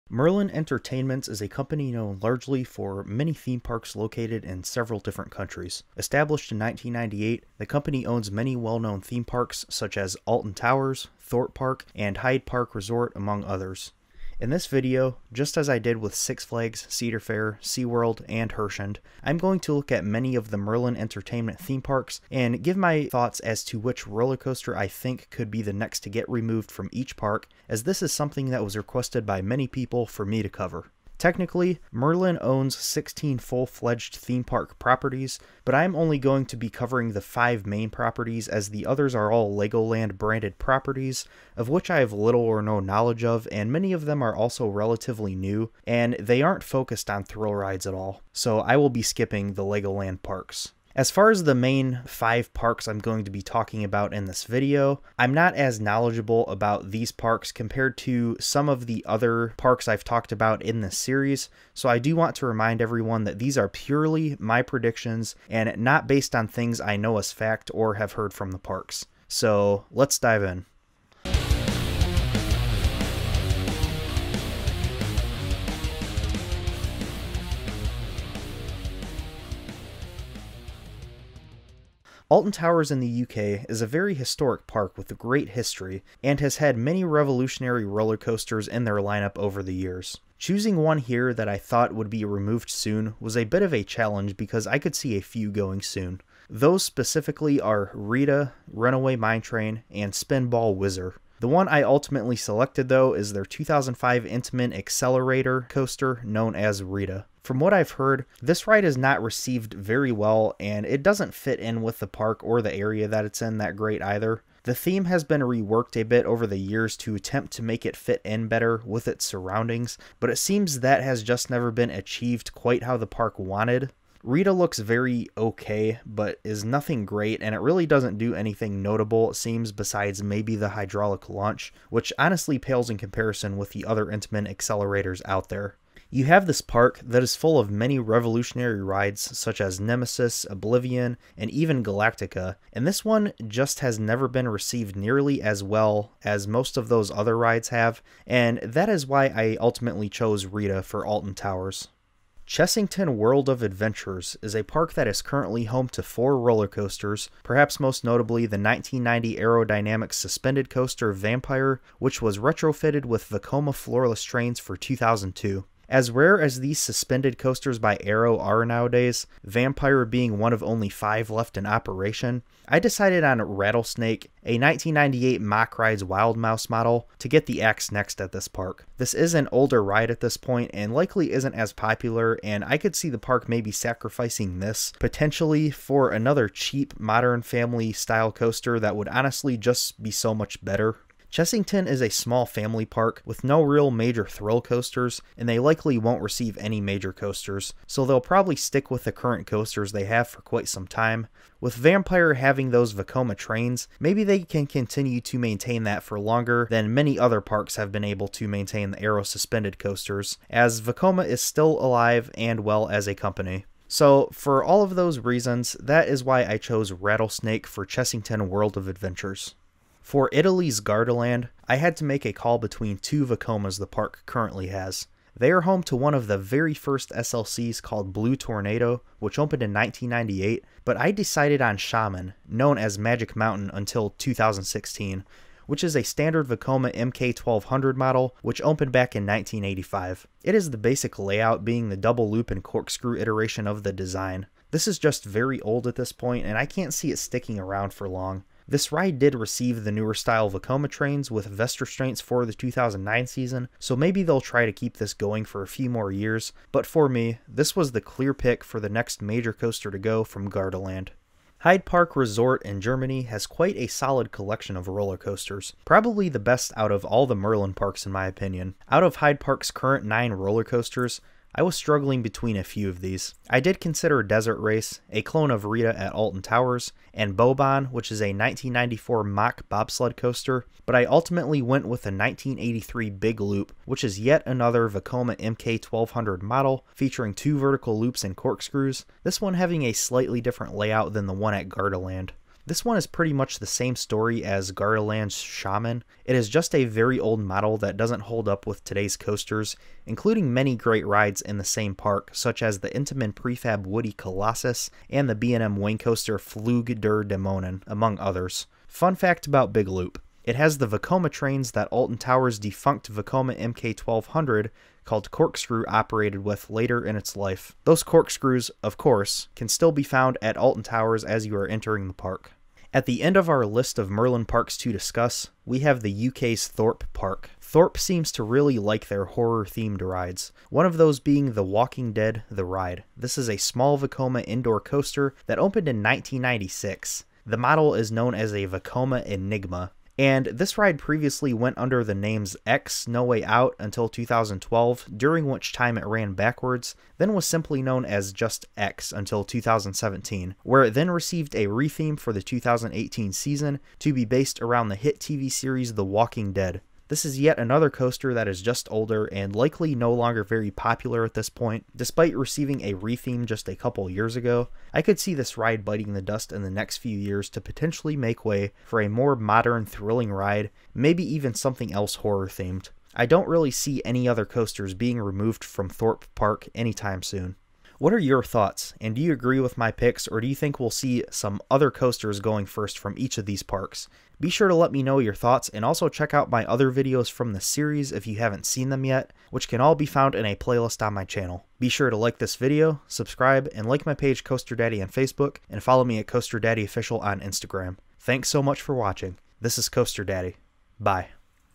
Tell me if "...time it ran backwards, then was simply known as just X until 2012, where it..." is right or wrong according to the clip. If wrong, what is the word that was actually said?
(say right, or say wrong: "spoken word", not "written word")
wrong: "2017", not "2012".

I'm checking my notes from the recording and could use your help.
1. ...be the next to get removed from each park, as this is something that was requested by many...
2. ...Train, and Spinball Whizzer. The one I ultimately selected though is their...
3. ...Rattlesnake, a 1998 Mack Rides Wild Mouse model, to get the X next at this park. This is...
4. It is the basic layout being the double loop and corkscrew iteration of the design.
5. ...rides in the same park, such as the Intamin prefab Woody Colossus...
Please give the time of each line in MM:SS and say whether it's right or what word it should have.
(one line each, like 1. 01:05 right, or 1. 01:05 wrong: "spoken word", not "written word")
1. 00:25 right
2. 01:39 right
3. 02:53 right
4. 04:00 right
5. 05:01 right.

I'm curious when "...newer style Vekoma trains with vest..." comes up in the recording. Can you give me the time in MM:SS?
04:09.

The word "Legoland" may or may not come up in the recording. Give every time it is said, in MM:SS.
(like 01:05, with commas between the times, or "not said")
00:39, 00:49.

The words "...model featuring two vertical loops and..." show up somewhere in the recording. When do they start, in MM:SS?
04:46.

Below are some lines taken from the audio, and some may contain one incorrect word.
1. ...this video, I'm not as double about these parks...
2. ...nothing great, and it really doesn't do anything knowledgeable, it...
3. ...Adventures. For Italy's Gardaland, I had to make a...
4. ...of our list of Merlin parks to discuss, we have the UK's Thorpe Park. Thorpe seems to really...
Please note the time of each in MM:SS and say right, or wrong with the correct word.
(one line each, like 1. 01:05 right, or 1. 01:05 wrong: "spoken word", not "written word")
1. 00:54 wrong: "knowledgeable", not "double"
2. 02:06 wrong: "notable", not "knowledgeable"
3. 03:38 right
4. 05:23 right.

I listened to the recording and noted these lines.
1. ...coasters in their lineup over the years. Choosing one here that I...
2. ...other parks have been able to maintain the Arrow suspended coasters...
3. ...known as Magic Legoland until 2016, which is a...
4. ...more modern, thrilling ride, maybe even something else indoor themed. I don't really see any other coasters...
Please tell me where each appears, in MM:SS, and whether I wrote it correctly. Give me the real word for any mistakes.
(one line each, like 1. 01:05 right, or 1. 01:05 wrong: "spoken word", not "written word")
1. 01:28 right
2. 03:27 right
3. 03:52 wrong: "Mountain", not "Legoland"
4. 06:09 wrong: "horror", not "indoor".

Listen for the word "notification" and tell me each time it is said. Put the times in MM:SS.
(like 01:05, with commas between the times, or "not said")
not said.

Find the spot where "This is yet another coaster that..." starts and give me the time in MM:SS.
05:57.